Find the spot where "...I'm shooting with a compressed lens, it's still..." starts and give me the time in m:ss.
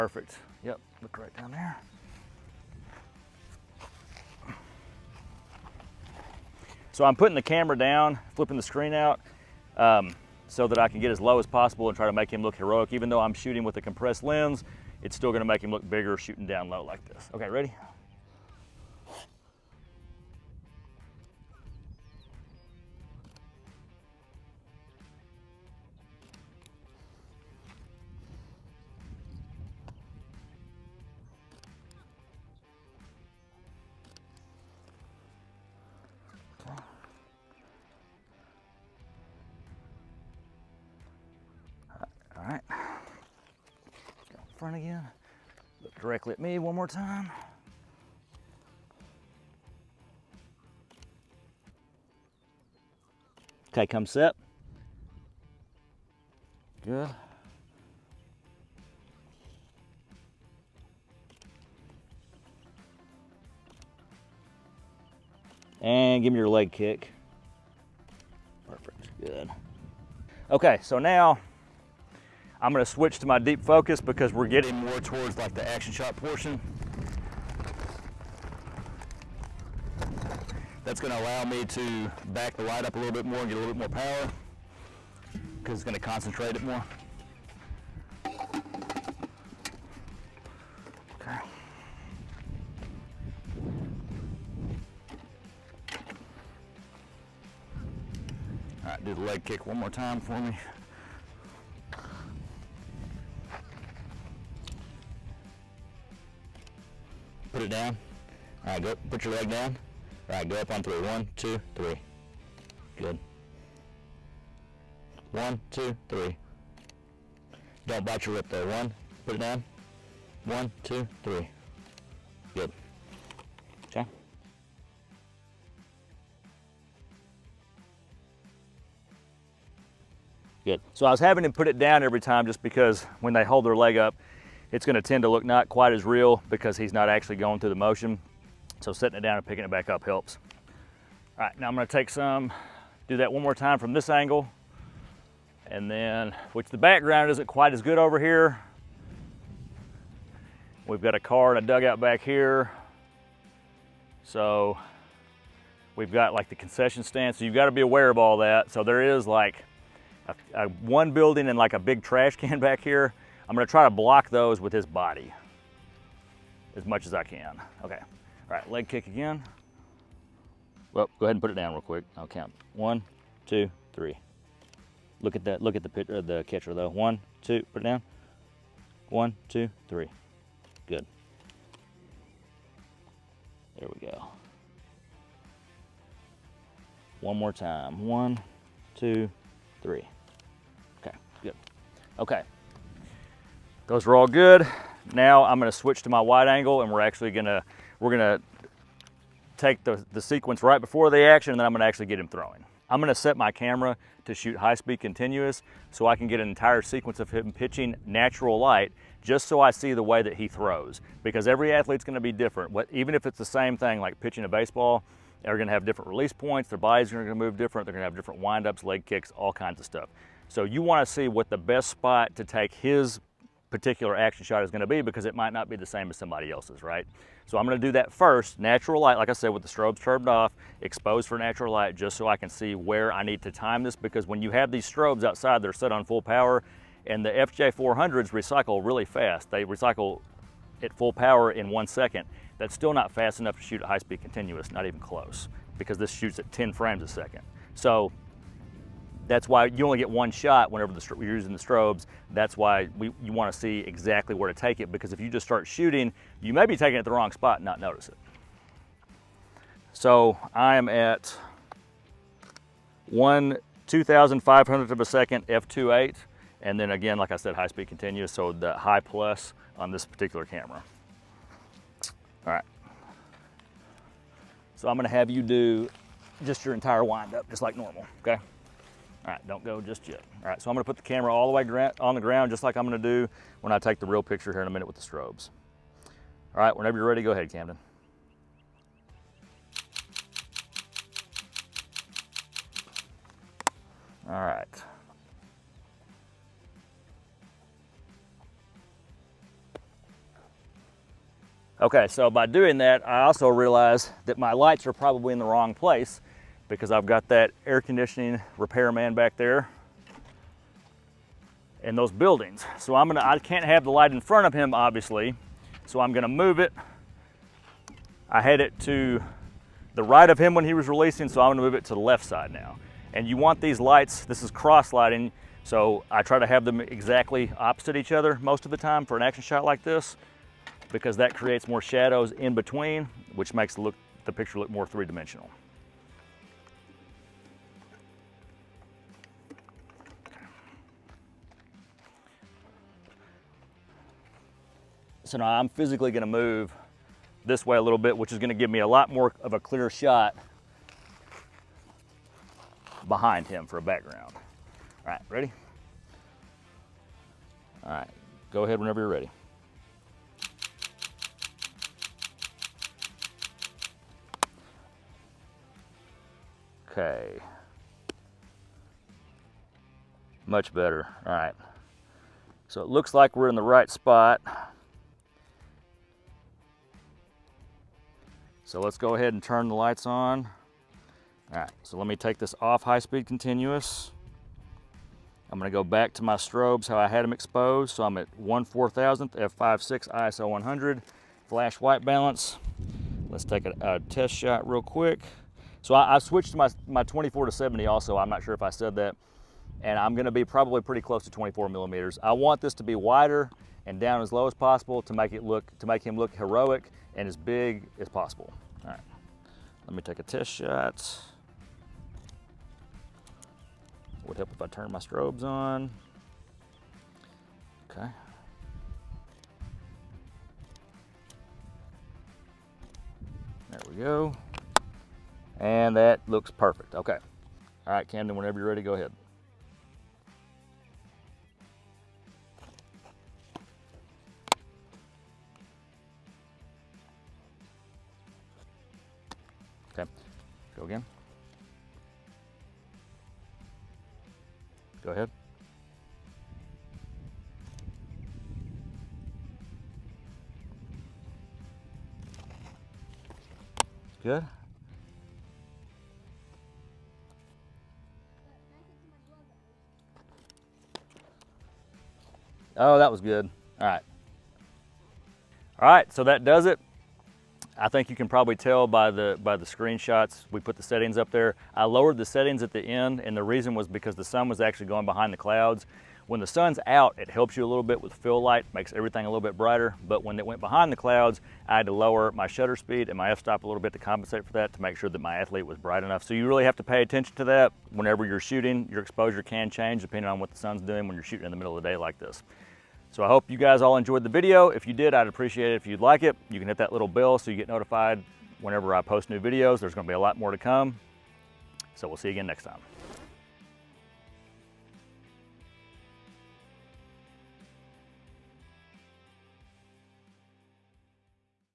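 0:13.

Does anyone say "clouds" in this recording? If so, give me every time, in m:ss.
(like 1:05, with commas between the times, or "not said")
7:55, 8:00.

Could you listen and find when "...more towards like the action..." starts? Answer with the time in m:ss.
1:14.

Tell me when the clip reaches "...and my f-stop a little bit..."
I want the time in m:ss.
8:03.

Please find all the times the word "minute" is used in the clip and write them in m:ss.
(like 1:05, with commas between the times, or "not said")
4:44.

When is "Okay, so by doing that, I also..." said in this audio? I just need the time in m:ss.
5:01.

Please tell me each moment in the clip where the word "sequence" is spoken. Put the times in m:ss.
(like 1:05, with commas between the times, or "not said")
3:20, 3:26.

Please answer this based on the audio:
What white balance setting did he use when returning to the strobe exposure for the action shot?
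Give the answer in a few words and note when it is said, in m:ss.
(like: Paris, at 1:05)
flash, at 6:31.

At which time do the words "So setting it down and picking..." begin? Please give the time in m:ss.
2:18.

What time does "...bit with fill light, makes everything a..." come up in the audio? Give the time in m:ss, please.
7:57.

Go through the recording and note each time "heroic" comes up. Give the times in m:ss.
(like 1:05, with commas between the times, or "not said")
0:12, 6:46.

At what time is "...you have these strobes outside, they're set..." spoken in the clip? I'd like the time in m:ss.
3:54.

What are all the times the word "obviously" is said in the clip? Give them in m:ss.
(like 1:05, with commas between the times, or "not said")
5:14.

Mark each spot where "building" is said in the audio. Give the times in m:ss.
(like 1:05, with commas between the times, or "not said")
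2:41, 5:12.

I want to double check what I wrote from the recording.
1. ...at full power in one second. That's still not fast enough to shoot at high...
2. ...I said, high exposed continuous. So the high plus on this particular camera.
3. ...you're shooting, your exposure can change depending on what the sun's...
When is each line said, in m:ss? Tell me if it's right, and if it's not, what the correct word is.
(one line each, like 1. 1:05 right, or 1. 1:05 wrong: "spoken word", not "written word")
1. 4:00 right
2. 4:27 wrong: "speed", not "exposed"
3. 8:08 right.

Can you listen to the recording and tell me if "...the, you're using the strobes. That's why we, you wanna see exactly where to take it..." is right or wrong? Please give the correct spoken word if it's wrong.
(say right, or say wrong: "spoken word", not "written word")
right.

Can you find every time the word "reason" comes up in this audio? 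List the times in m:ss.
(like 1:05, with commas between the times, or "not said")
7:53.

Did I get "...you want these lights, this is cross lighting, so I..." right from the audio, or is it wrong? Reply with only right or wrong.
right.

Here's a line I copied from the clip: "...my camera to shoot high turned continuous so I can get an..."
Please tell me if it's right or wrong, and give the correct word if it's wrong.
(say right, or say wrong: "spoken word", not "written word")
wrong: "speed", not "turned".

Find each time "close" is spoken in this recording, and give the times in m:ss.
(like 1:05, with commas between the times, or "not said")
4:04, 6:40.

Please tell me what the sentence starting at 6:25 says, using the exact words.
I'm gonna go back to my strobes, how I had them exposed.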